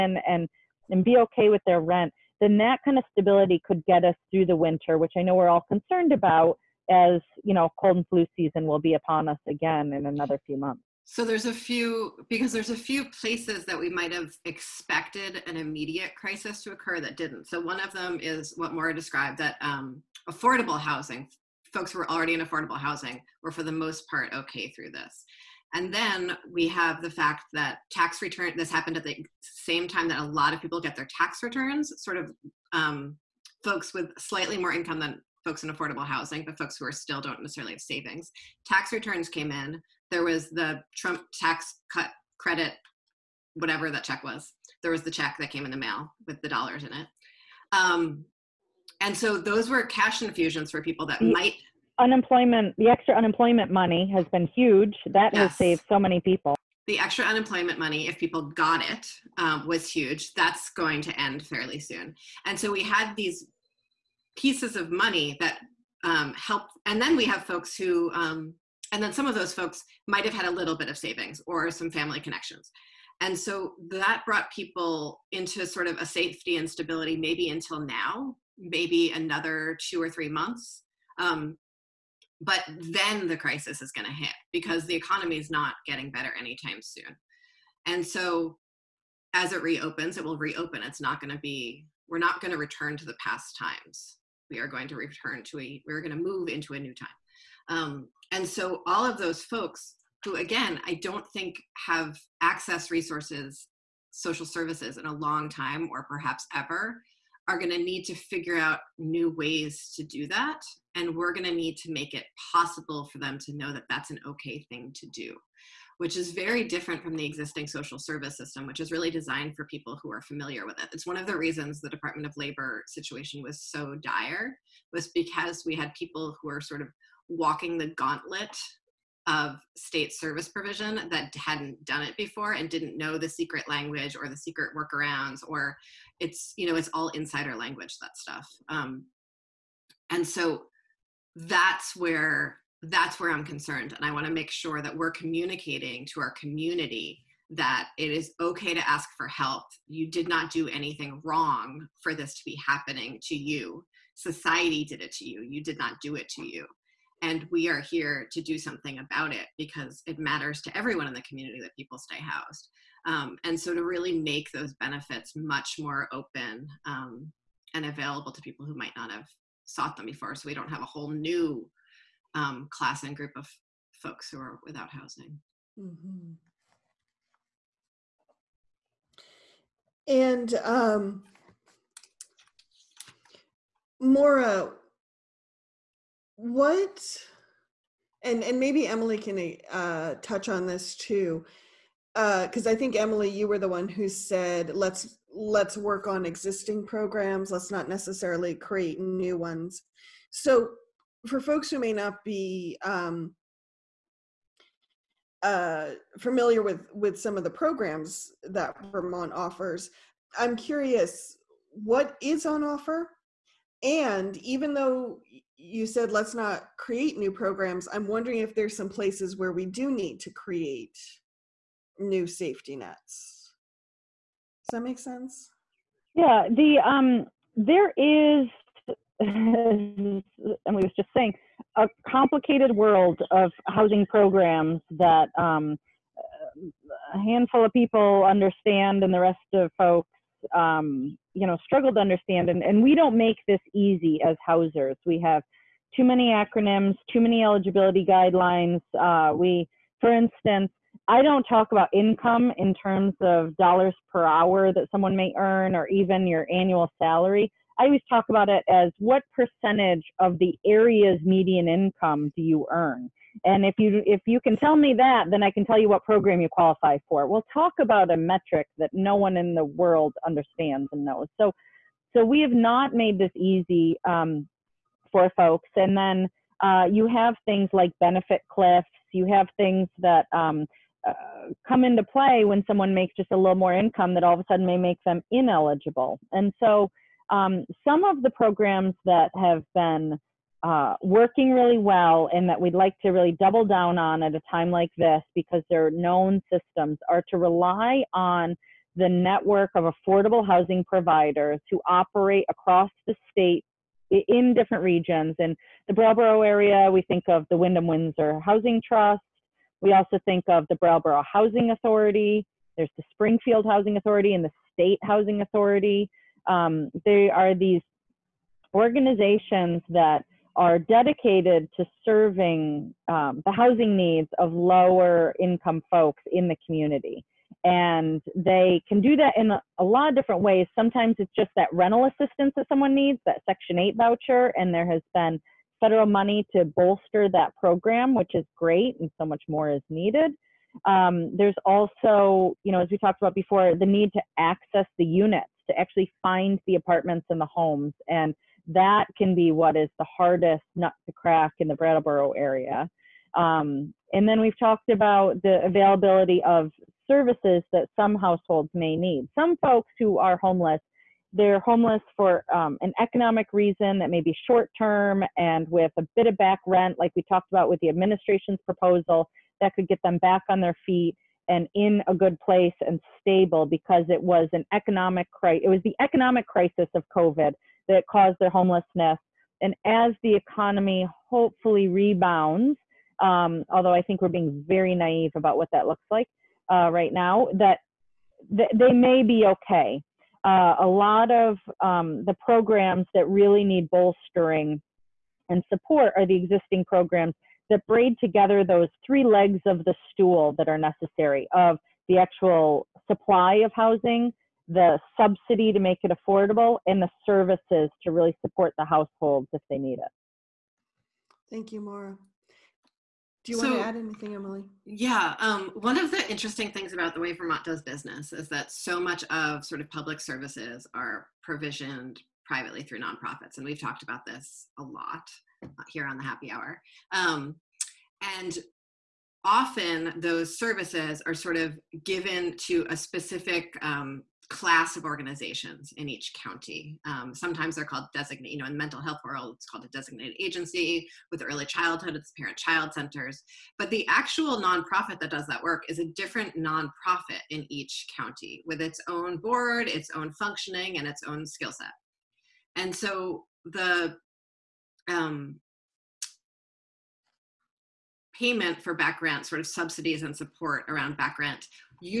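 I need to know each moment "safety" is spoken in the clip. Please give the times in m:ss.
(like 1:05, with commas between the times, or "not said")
1:16, 3:42.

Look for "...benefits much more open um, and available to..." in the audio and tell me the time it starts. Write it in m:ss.
2:44.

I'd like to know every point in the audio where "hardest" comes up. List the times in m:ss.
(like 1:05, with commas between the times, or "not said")
5:50.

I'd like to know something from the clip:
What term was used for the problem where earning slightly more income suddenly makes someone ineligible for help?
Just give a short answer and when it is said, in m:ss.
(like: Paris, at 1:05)
benefit cliffs, at 4:37.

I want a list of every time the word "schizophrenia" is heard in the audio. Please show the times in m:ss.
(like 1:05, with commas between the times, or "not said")
not said.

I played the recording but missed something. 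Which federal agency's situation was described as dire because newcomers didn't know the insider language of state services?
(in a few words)
Department of Labor.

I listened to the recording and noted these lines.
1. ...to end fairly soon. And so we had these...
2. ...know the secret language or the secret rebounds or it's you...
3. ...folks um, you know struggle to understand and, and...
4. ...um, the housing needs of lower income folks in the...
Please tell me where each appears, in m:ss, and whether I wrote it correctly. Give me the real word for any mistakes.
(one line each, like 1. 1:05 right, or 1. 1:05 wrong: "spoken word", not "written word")
1. 1:01 right
2. 2:12 wrong: "workarounds", not "rebounds"
3. 3:59 right
4. 5:23 right.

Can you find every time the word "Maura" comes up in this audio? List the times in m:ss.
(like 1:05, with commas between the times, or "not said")
0:18, 3:04, 6:51.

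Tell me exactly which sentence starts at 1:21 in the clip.
Um, but then the crisis is going to hit because the economy is not getting better anytime soon.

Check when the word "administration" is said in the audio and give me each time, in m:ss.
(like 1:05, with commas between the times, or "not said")
6:07.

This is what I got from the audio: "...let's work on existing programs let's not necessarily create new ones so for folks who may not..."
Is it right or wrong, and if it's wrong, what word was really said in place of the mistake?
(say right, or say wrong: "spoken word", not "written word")
right.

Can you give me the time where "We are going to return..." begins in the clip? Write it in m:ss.
1:34.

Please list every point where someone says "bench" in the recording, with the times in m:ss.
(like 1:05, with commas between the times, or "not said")
not said.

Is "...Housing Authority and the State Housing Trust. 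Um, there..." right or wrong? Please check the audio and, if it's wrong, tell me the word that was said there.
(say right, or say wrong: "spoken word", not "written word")
wrong: "Authority", not "Trust".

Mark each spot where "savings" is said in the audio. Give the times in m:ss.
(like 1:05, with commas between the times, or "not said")
0:37, 1:10.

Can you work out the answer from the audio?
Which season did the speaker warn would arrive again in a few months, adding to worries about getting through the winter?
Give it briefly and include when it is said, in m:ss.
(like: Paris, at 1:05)
cold and flu season, at 0:07.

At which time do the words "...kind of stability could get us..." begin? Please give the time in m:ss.
0:02.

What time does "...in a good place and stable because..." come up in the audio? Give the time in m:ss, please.
6:11.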